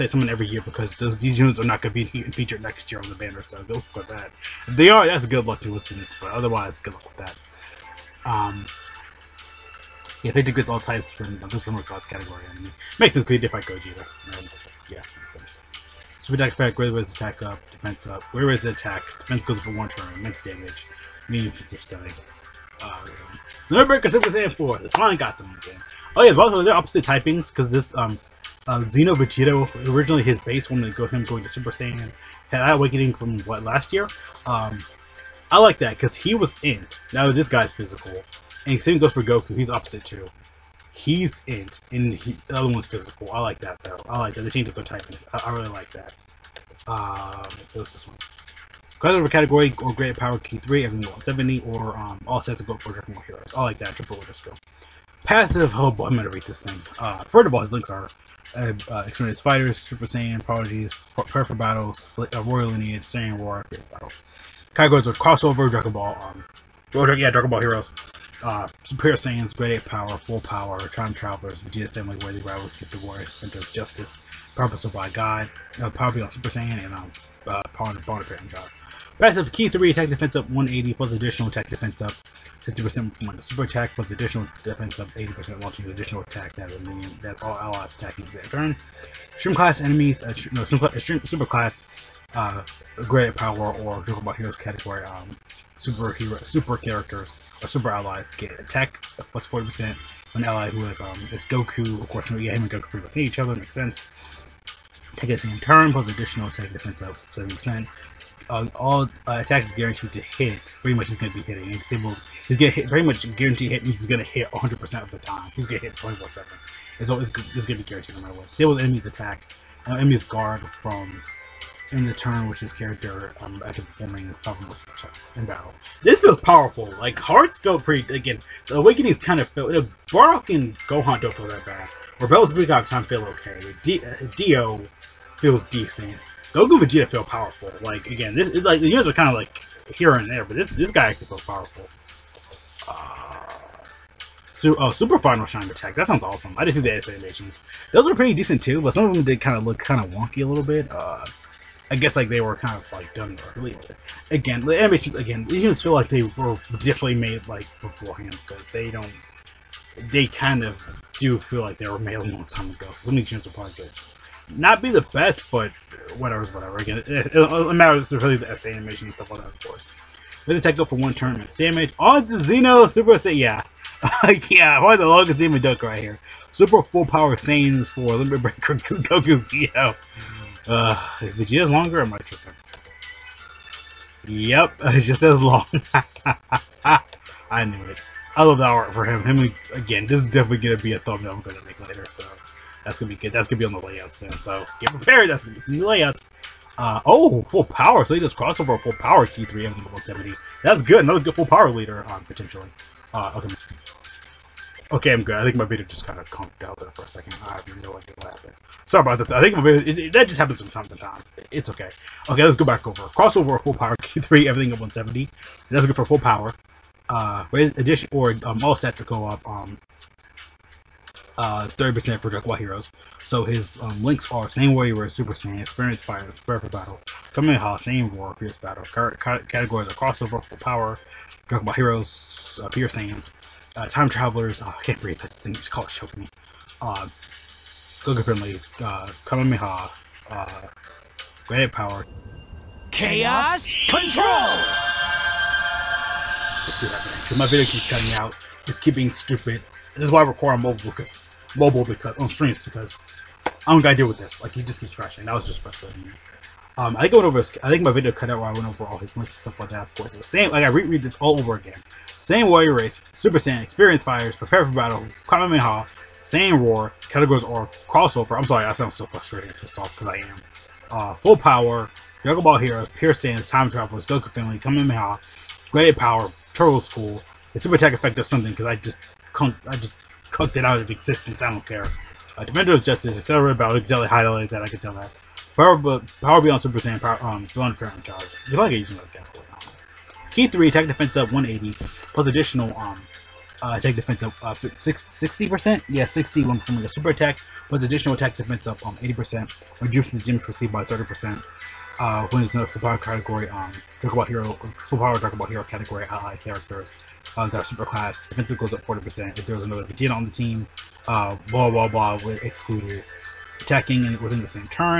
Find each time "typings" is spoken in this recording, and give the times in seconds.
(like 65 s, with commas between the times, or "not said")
27 s, 44 s.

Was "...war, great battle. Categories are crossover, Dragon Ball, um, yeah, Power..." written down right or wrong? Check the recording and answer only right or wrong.
wrong.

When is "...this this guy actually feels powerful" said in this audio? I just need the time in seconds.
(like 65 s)
140 s.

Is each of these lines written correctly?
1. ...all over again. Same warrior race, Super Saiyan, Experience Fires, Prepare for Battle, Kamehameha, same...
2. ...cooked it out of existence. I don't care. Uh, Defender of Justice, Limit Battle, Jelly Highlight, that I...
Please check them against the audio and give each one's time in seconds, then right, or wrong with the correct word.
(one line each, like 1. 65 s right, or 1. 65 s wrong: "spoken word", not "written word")
1. 261 s right
2. 280 s wrong: "Accelerated", not "Limit".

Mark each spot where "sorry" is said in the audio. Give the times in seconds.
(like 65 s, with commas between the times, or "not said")
208 s, 268 s.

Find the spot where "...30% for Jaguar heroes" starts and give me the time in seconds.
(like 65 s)
221 s.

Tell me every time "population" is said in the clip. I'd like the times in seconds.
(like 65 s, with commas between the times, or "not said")
not said.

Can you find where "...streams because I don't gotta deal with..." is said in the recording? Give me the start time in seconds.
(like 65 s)
252 s.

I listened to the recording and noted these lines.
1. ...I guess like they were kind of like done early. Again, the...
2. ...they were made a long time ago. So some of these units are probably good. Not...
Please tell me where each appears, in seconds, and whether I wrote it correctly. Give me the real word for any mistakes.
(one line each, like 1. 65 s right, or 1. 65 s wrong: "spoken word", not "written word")
1. 151 s right
2. 161 s right.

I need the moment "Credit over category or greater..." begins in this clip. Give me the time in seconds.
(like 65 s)
49 s.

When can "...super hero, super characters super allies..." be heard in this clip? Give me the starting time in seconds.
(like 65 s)
95 s.